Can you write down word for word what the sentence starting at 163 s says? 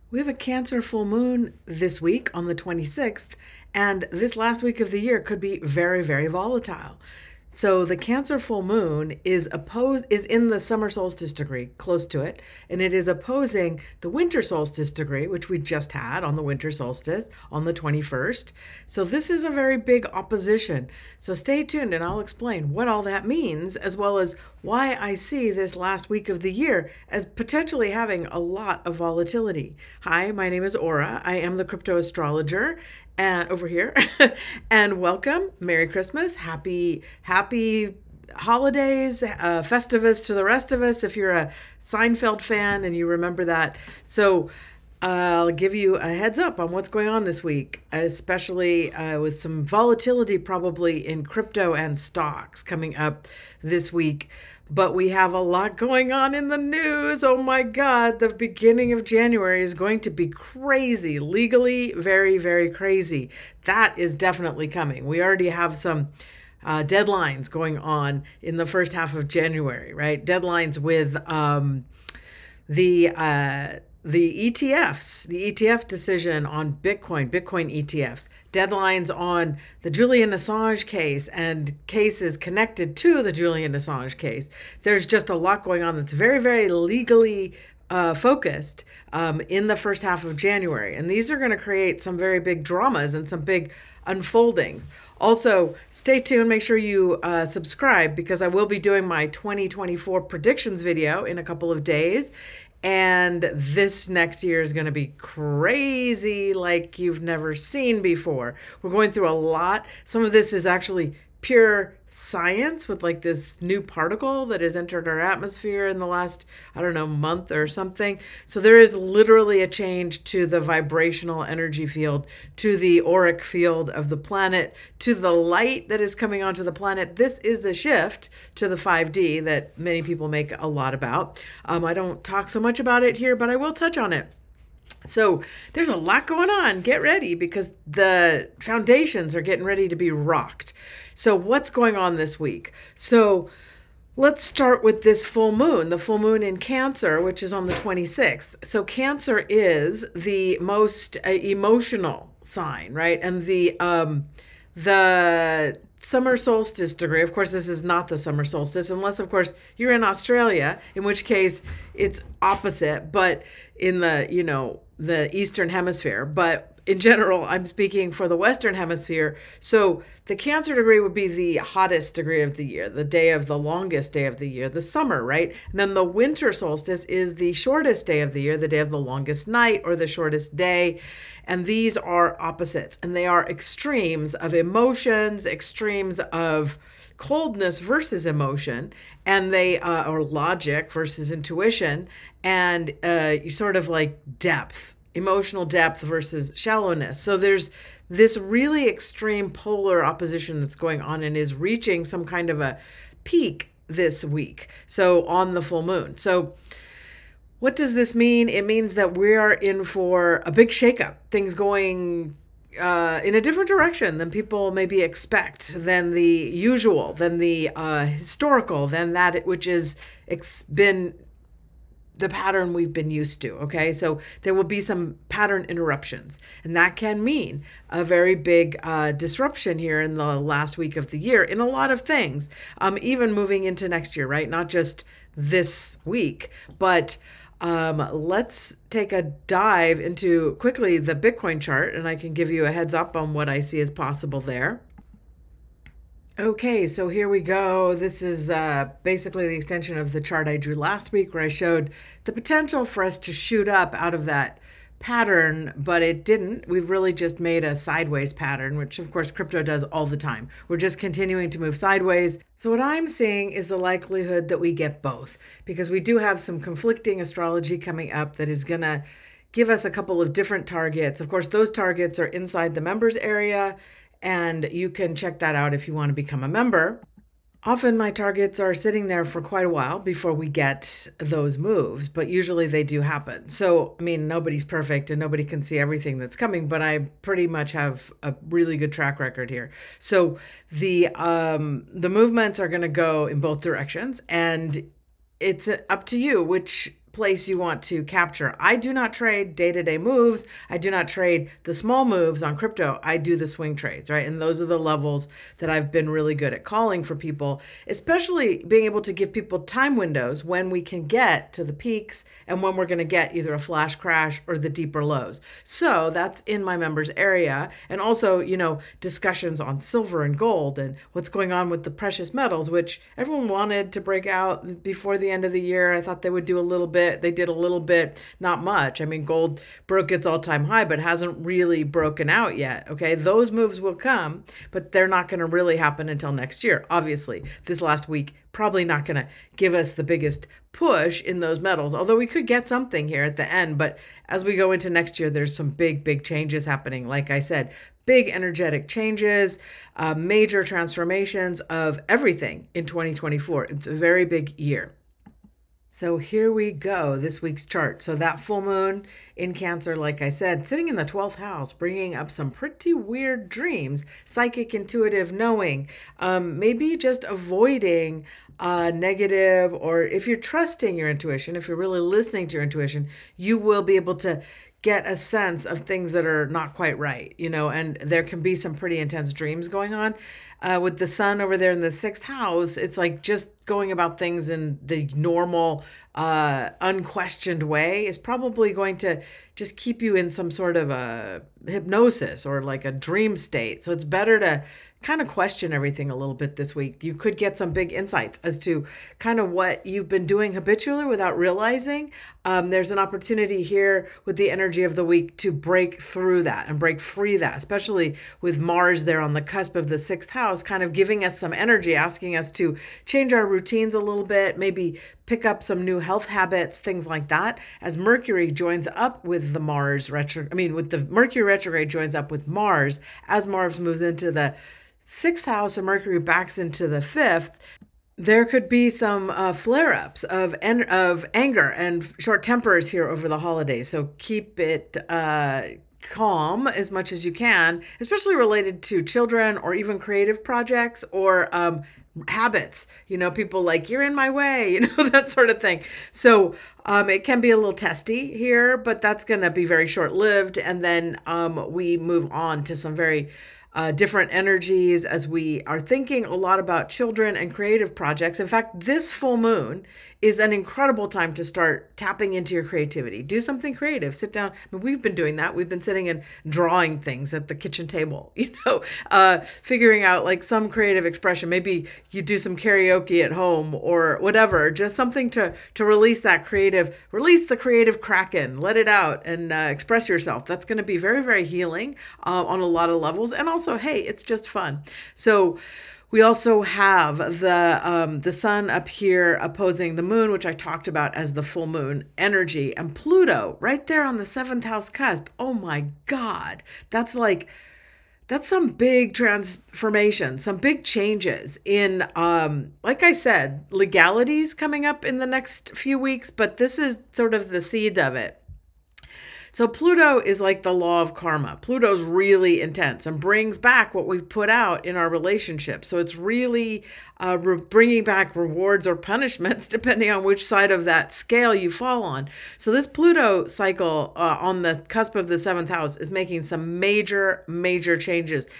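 But in the, you know, the Eastern Hemisphere, but in general, I'm speaking for the Western Hemisphere.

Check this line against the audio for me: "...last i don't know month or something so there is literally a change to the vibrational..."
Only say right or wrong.
right.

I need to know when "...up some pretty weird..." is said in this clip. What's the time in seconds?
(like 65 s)
362 s.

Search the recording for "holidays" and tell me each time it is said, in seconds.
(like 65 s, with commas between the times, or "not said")
38 s, 433 s.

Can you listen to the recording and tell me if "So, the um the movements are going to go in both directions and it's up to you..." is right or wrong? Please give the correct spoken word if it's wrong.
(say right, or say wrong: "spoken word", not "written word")
right.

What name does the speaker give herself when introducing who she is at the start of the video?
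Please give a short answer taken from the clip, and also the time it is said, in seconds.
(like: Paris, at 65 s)
Aura, at 30 s.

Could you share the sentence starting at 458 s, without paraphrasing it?
In fact, this full moon is an incredible time to start tapping into your creativity.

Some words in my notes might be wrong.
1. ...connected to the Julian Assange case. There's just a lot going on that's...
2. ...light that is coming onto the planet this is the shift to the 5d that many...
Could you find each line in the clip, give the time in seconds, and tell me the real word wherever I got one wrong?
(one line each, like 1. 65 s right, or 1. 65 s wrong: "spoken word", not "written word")
1. 82 s right
2. 125 s right.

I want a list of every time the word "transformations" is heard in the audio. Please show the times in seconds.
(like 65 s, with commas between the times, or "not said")
350 s, 499 s.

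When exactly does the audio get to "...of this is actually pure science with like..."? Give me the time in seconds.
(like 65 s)
110 s.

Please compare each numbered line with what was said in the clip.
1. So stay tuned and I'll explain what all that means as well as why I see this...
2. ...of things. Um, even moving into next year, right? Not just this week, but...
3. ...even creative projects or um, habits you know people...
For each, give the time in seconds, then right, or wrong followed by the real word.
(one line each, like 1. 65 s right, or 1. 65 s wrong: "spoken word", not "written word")
1. 21 s right
2. 231 s right
3. 439 s right.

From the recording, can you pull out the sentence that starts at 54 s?
But we have a lot going on in the news.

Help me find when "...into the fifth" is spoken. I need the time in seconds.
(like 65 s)
426 s.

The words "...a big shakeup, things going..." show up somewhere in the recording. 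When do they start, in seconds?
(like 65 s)
210 s.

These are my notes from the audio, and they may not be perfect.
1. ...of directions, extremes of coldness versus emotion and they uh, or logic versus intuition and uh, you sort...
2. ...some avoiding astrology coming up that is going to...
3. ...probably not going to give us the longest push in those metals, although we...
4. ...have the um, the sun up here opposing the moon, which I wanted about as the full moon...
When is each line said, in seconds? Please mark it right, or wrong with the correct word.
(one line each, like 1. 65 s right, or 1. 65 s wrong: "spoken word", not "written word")
1. 184 s wrong: "emotions", not "directions"
2. 266 s wrong: "conflicting", not "avoiding"
3. 338 s wrong: "biggest", not "longest"
4. 486 s wrong: "talked", not "wanted".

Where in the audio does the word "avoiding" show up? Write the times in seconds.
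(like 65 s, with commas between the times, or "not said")
367 s.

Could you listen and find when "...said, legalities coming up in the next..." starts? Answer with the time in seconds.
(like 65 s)
503 s.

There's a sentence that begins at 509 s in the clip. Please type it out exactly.
So Pluto is like the law of karma.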